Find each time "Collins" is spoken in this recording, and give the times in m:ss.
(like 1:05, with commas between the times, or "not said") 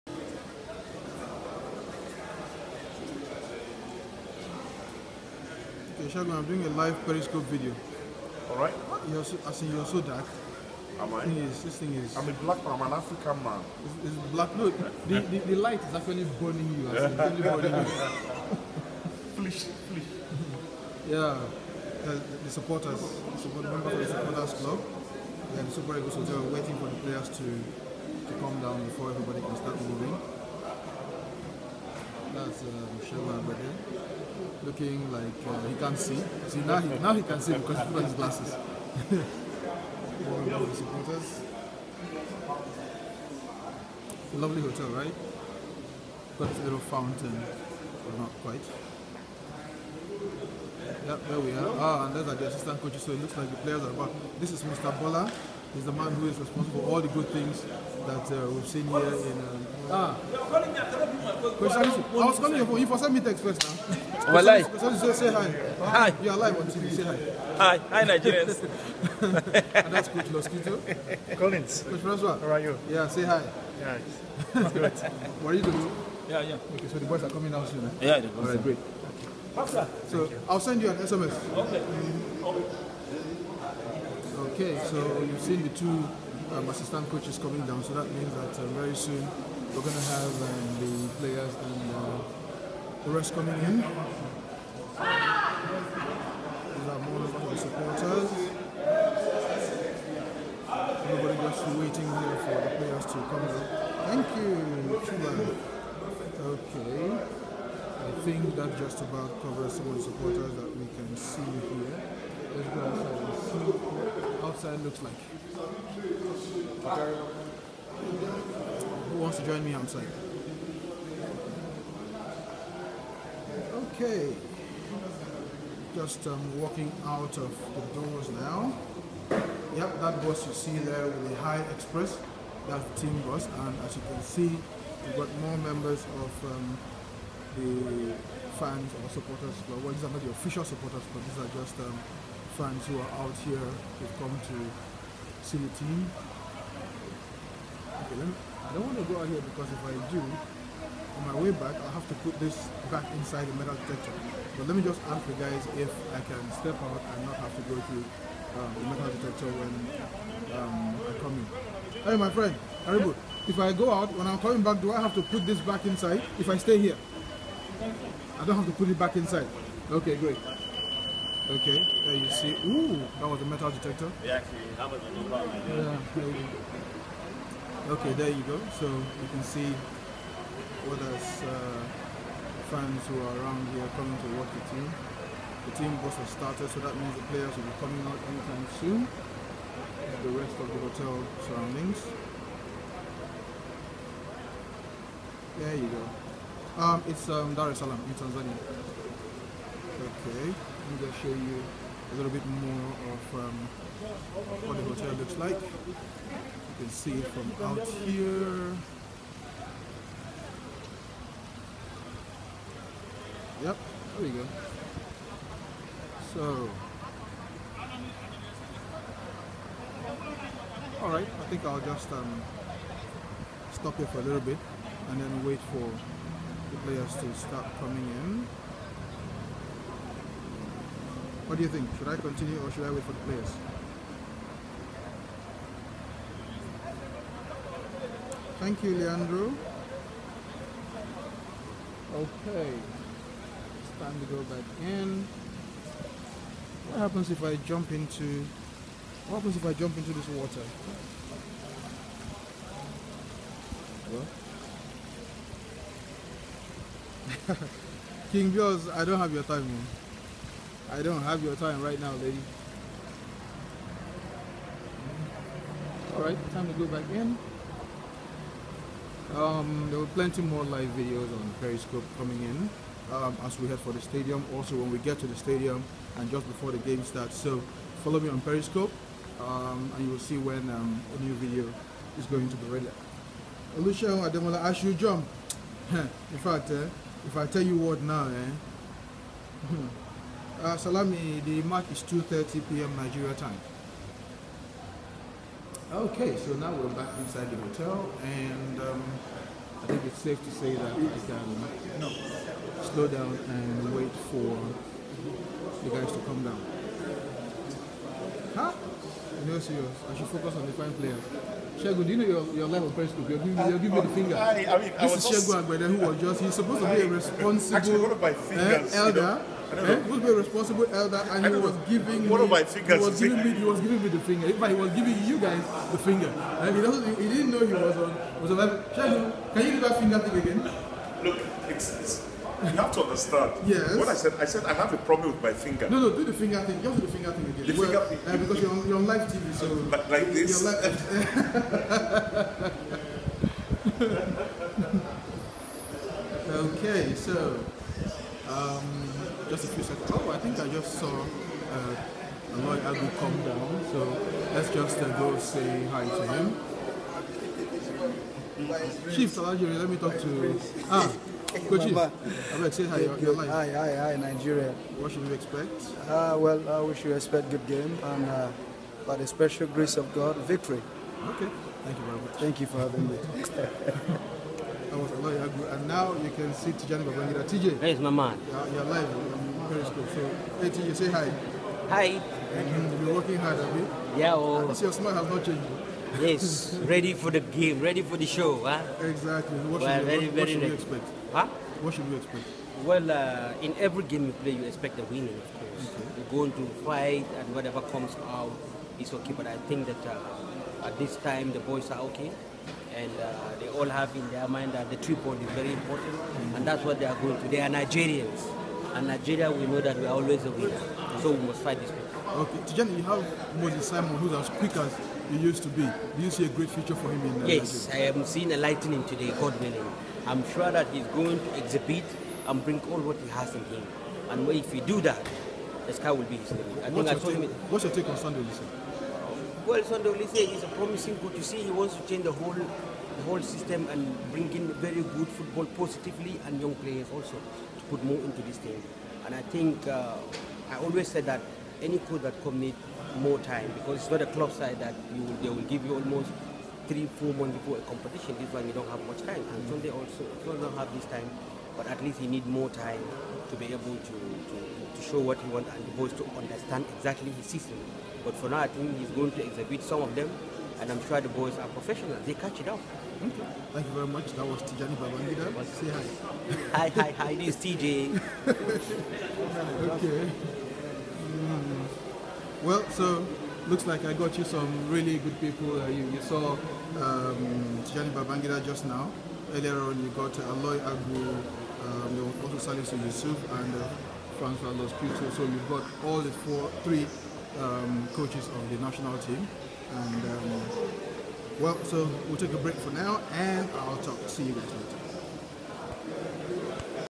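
1:11.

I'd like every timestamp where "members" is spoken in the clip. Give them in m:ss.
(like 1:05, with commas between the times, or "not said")
0:23, 2:15.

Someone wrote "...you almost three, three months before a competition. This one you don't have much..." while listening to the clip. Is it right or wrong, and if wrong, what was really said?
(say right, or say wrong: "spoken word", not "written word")
wrong: "four", not "three".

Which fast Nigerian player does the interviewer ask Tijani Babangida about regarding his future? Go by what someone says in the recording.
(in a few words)
Moses Simon.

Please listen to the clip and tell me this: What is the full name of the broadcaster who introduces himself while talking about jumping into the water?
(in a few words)
Olusegun Ademola.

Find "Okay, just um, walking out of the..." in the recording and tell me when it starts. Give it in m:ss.
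2:03.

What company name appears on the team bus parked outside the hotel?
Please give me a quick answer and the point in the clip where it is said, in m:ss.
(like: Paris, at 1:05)
High Express, at 2:11.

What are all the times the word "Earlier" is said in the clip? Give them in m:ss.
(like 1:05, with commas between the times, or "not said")
7:59.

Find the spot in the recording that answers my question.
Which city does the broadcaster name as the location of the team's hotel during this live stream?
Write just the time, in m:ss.
3:17.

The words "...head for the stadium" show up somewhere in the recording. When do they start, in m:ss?
4:33.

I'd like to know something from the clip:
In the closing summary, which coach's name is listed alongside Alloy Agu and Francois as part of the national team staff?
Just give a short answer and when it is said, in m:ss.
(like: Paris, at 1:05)
Salisu Yusuf, at 8:02.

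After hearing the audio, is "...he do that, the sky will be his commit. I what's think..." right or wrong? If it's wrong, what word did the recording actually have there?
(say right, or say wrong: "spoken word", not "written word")
wrong: "limit", not "commit".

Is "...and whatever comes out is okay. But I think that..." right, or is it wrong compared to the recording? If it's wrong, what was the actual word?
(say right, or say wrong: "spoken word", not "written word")
right.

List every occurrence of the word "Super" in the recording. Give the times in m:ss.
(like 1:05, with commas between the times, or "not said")
0:25.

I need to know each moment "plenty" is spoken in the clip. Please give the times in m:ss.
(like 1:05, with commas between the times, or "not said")
4:30.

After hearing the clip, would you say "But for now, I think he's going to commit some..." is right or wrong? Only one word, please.
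wrong.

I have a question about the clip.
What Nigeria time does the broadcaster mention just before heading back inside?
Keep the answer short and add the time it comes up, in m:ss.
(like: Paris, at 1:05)
2:30 p.m., at 4:52.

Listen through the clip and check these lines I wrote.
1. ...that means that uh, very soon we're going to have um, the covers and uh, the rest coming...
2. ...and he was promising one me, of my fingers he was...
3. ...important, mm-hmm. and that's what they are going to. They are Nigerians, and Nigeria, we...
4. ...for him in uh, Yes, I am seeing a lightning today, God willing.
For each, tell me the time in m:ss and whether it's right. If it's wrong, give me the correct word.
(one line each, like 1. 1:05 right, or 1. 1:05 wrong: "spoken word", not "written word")
1. 1:27 wrong: "players", not "covers"
2. 5:21 wrong: "giving", not "promising"
3. 6:45 right
4. 6:56 right.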